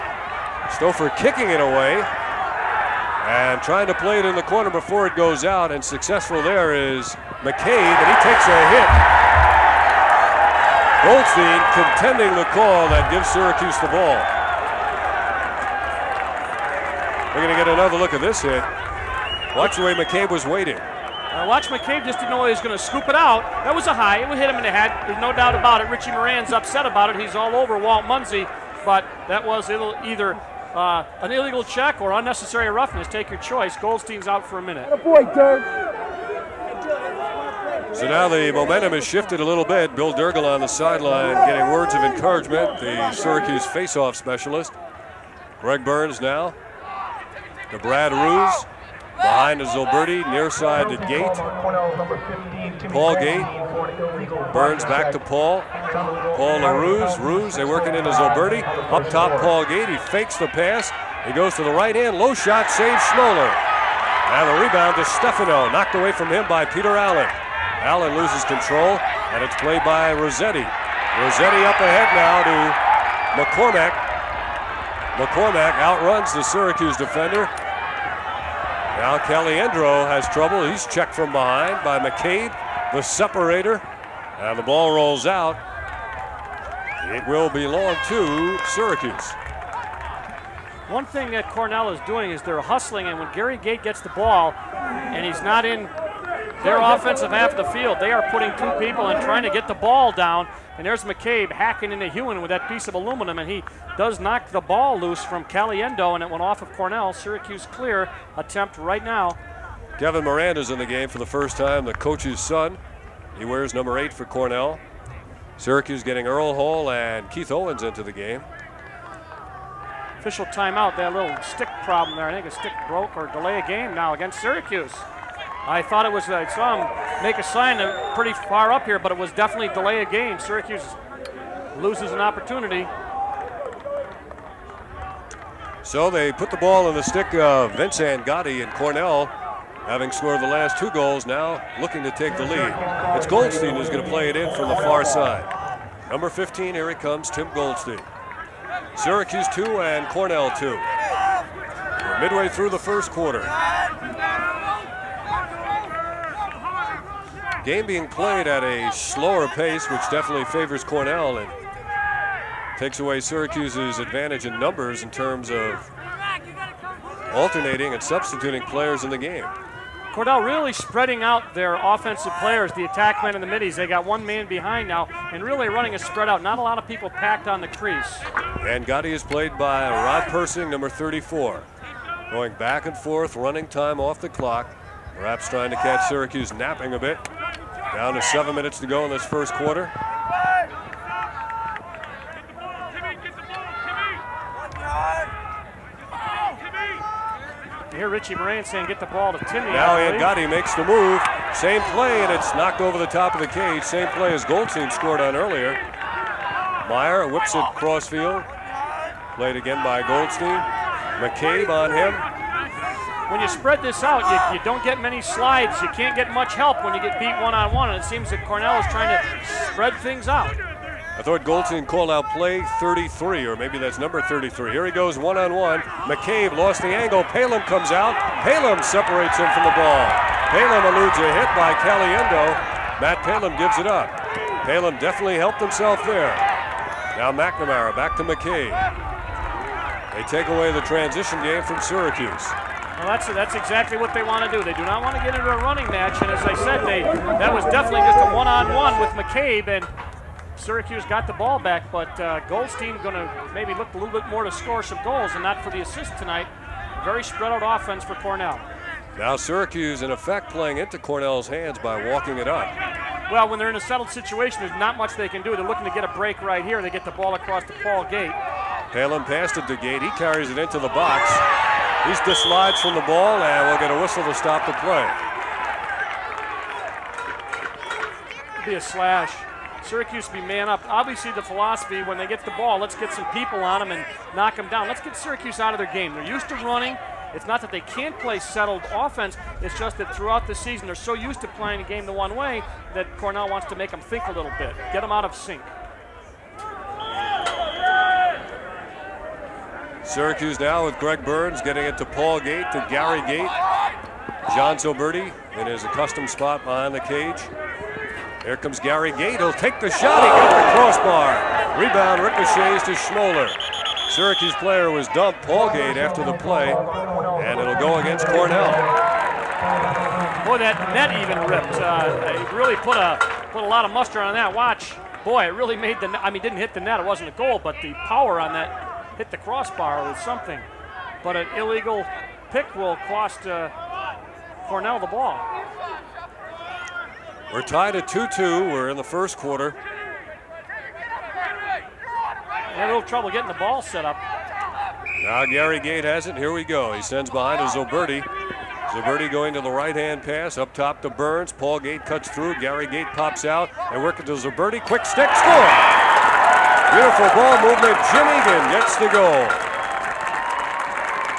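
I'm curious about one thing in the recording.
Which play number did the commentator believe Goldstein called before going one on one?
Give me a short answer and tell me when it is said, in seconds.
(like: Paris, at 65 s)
33, at 222 s.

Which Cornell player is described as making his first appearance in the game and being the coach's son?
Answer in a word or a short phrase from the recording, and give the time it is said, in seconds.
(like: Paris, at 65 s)
Kevin Miranda, at 109 s.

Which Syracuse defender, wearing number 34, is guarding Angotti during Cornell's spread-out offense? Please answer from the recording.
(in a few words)
Rod Persing.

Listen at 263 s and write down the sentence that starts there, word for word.
Well, when they're in a settled situation, there's not much they can do.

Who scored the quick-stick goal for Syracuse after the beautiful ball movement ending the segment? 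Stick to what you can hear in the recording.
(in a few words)
Jim Egan.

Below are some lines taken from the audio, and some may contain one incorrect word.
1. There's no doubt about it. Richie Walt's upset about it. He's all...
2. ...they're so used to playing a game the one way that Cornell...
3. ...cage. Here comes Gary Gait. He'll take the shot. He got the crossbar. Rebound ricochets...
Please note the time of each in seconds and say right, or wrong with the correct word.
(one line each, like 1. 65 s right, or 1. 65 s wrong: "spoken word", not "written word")
1. 25 s wrong: "Moran", not "Walt"
2. 290 s right
3. 306 s right.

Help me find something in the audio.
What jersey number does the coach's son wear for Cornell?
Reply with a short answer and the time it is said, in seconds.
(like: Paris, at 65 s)
8, at 113 s.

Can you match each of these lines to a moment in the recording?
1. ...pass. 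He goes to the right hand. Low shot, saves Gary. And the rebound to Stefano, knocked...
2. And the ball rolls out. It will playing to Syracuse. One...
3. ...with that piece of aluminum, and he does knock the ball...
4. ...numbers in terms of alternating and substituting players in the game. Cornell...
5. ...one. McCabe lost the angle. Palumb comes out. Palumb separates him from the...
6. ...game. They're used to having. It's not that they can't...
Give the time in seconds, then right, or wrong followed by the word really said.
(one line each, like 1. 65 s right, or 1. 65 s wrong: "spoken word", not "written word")
1. 60 s wrong: "Schimoler", not "Gary"
2. 84 s wrong: "belong", not "playing"
3. 102 s right
4. 164 s right
5. 225 s right
6. 285 s wrong: "running", not "having".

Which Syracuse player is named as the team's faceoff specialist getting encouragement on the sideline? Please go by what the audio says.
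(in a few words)
Bill Dirrigl.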